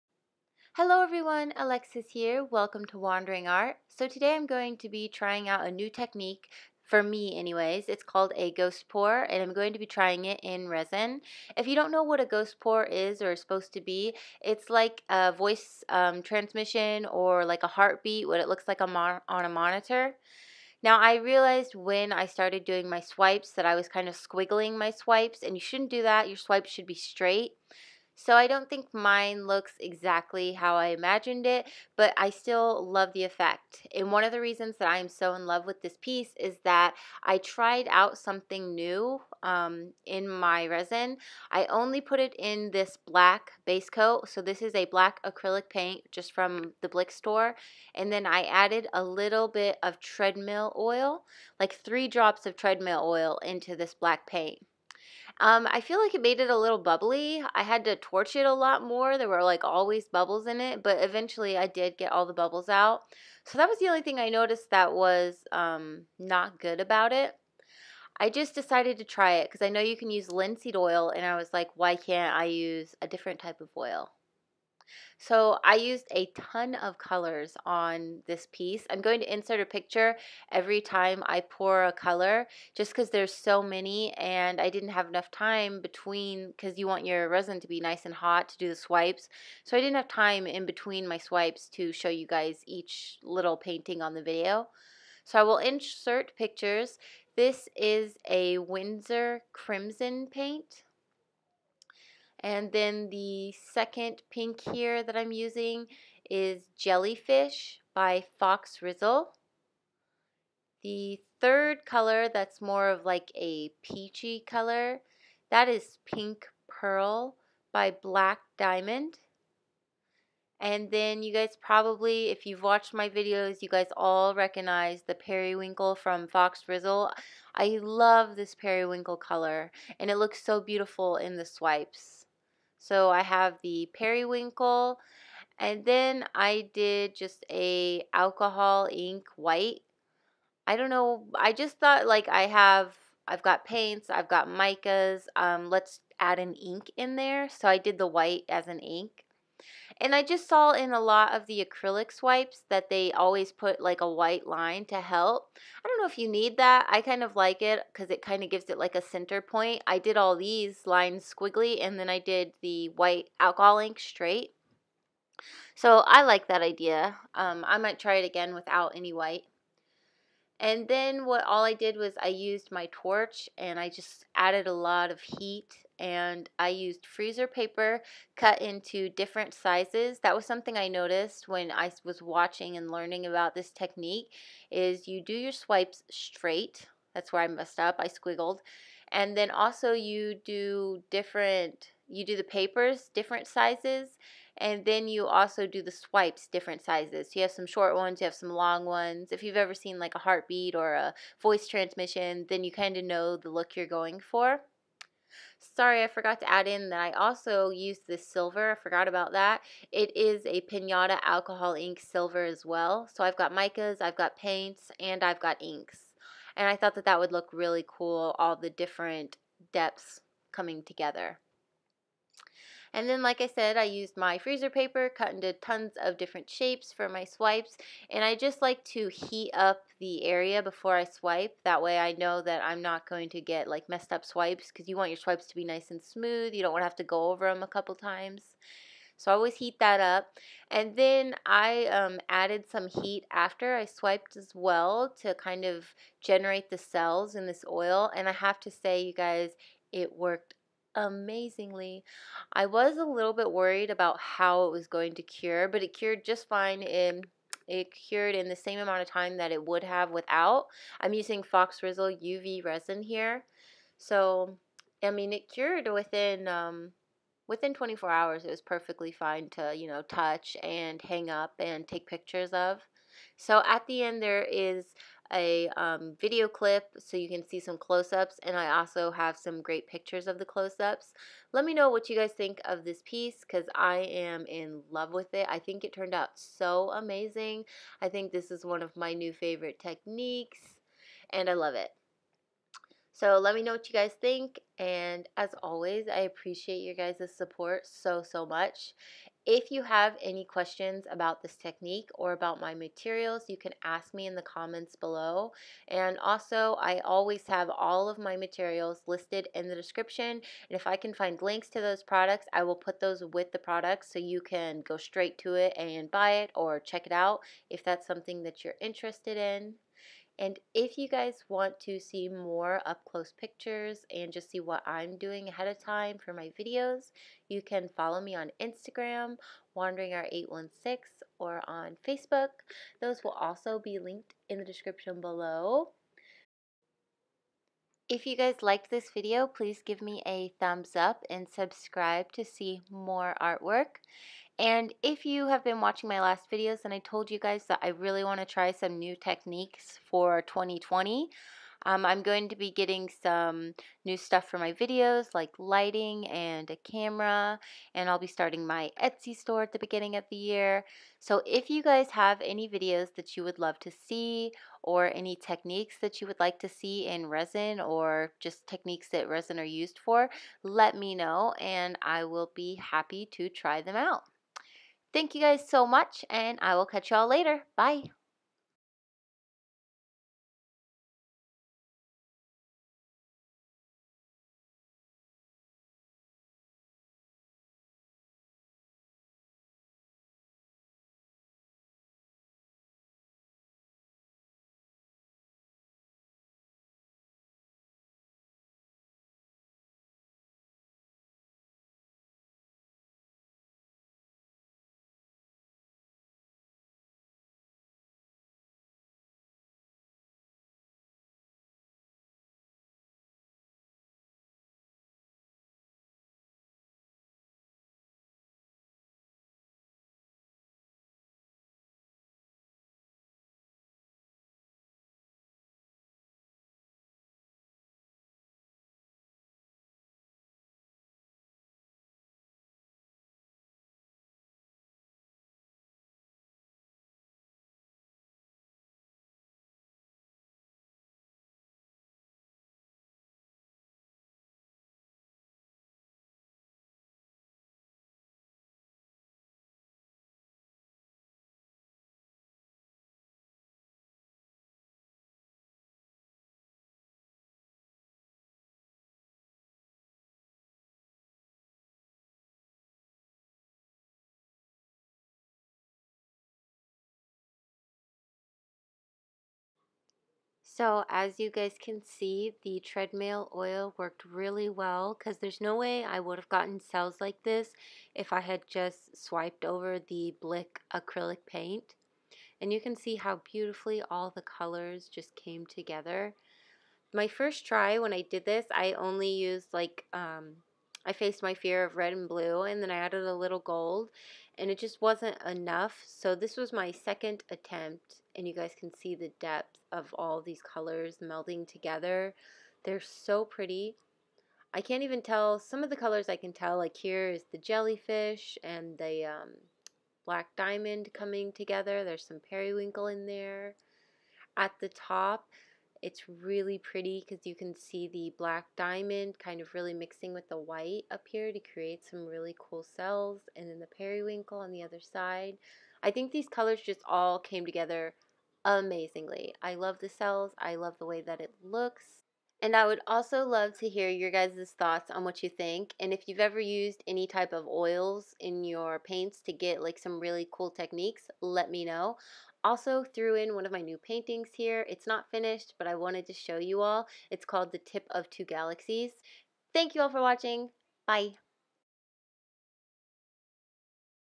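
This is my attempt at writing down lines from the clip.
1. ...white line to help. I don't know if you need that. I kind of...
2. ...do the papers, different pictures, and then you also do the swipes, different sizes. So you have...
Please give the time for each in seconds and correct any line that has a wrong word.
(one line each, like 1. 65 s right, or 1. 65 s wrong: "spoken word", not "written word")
1. 154 s right
2. 192 s wrong: "sizes", not "pictures".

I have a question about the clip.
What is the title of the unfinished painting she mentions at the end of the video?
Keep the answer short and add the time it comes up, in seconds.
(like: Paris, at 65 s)
The Tip of Two Galaxies, at 547 s.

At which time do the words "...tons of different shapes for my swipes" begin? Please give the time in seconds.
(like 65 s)
225 s.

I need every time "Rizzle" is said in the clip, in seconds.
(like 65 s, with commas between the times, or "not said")
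108 s, 126 s, 261 s.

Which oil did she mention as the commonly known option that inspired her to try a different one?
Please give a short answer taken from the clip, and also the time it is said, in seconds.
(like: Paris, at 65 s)
Linseed oil, at 70 s.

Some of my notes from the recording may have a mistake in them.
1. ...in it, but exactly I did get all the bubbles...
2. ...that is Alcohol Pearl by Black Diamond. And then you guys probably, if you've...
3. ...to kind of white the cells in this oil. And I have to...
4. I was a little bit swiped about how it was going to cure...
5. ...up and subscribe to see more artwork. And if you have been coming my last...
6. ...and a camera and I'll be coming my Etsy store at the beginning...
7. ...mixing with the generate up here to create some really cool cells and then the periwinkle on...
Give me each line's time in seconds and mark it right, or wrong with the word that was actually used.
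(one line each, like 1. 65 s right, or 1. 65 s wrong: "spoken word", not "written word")
1. 60 s wrong: "eventually", not "exactly"
2. 115 s wrong: "Pink", not "Alcohol"
3. 245 s wrong: "generate", not "white"
4. 252 s wrong: "worried", not "swiped"
5. 340 s wrong: "watching", not "coming"
6. 356 s wrong: "starting", not "coming"
7. 519 s wrong: "white", not "generate".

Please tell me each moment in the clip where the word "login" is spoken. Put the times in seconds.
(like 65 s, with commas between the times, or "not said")
not said.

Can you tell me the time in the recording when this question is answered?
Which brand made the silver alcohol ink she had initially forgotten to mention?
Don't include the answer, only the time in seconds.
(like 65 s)
210 s.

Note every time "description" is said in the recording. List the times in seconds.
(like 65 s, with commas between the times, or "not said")
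309 s, 334 s.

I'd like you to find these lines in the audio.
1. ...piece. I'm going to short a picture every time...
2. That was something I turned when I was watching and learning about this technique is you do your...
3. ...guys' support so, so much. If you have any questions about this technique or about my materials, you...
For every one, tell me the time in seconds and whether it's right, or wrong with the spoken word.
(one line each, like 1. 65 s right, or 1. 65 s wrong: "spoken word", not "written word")
1. 78 s wrong: "insert", not "short"
2. 180 s wrong: "noticed", not "turned"
3. 296 s right.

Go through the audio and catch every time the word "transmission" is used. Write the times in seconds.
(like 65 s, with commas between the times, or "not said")
16 s, 201 s.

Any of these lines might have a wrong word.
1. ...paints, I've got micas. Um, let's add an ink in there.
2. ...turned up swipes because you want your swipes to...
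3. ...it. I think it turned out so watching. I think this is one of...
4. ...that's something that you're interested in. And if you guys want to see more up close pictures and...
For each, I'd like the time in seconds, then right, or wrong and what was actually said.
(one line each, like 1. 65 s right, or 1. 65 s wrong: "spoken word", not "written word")
1. 143 s right
2. 233 s wrong: "messed", not "turned"
3. 285 s wrong: "amazing", not "watching"
4. 317 s right.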